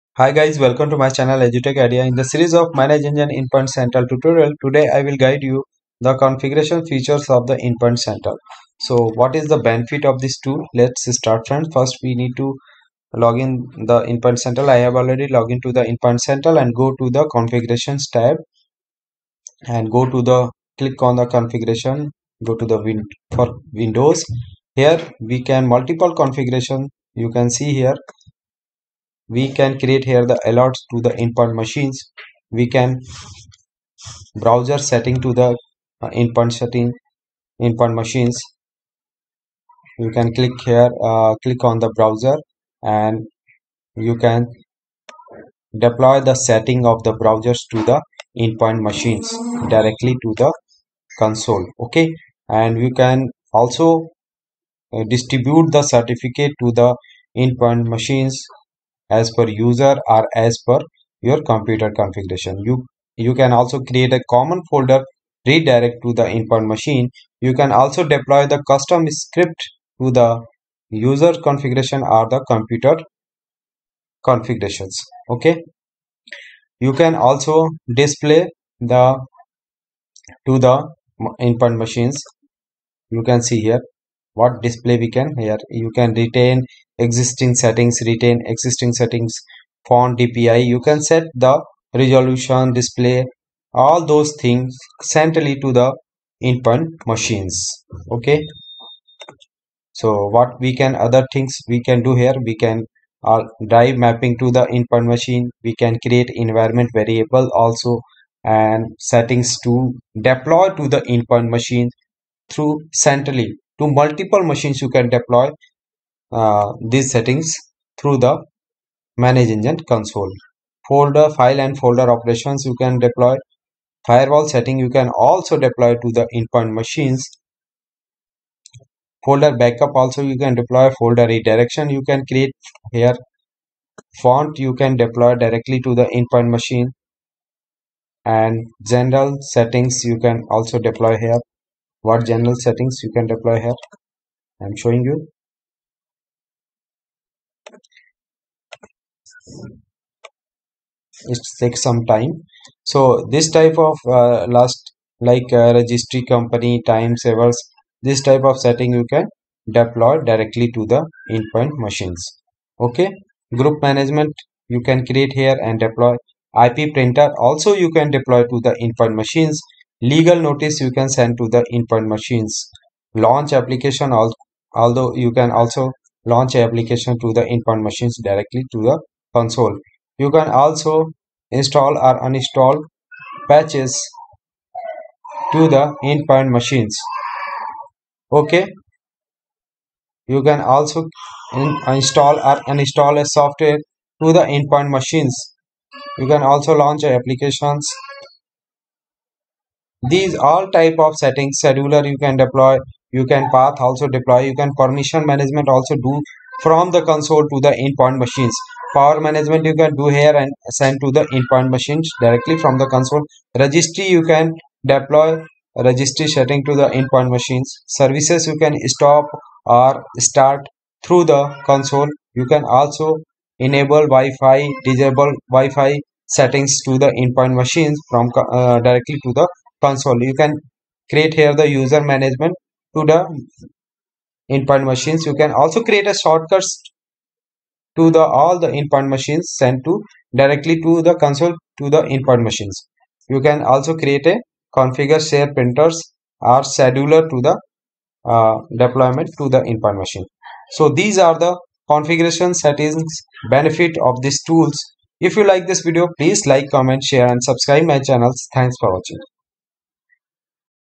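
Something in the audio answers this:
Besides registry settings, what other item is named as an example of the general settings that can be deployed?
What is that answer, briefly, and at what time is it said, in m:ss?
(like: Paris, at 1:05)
Time savers, at 2:36.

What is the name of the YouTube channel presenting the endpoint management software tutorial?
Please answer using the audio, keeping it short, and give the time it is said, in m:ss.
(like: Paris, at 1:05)
EduTech Idea, at 0:01.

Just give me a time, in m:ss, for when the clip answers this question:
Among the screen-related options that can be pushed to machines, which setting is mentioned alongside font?
1:30.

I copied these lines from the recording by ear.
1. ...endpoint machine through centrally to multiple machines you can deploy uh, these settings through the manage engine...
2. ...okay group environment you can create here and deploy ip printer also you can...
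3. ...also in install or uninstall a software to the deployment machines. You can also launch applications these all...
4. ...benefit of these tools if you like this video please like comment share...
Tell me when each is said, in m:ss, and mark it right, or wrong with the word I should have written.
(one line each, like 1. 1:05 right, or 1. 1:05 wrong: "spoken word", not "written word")
1. 1:51 right
2. 2:42 wrong: "management", not "environment"
3. 3:10 wrong: "endpoint", not "deployment"
4. 4:13 right.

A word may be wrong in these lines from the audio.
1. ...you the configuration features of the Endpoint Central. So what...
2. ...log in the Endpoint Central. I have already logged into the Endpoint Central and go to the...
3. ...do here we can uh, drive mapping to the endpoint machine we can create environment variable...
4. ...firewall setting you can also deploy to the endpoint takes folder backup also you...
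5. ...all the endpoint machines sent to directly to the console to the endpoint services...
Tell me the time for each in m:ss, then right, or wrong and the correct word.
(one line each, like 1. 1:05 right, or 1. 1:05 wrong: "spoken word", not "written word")
1. 0:05 right
2. 0:13 right
3. 1:42 right
4. 2:04 wrong: "machines", not "takes"
5. 3:58 wrong: "machines", not "services".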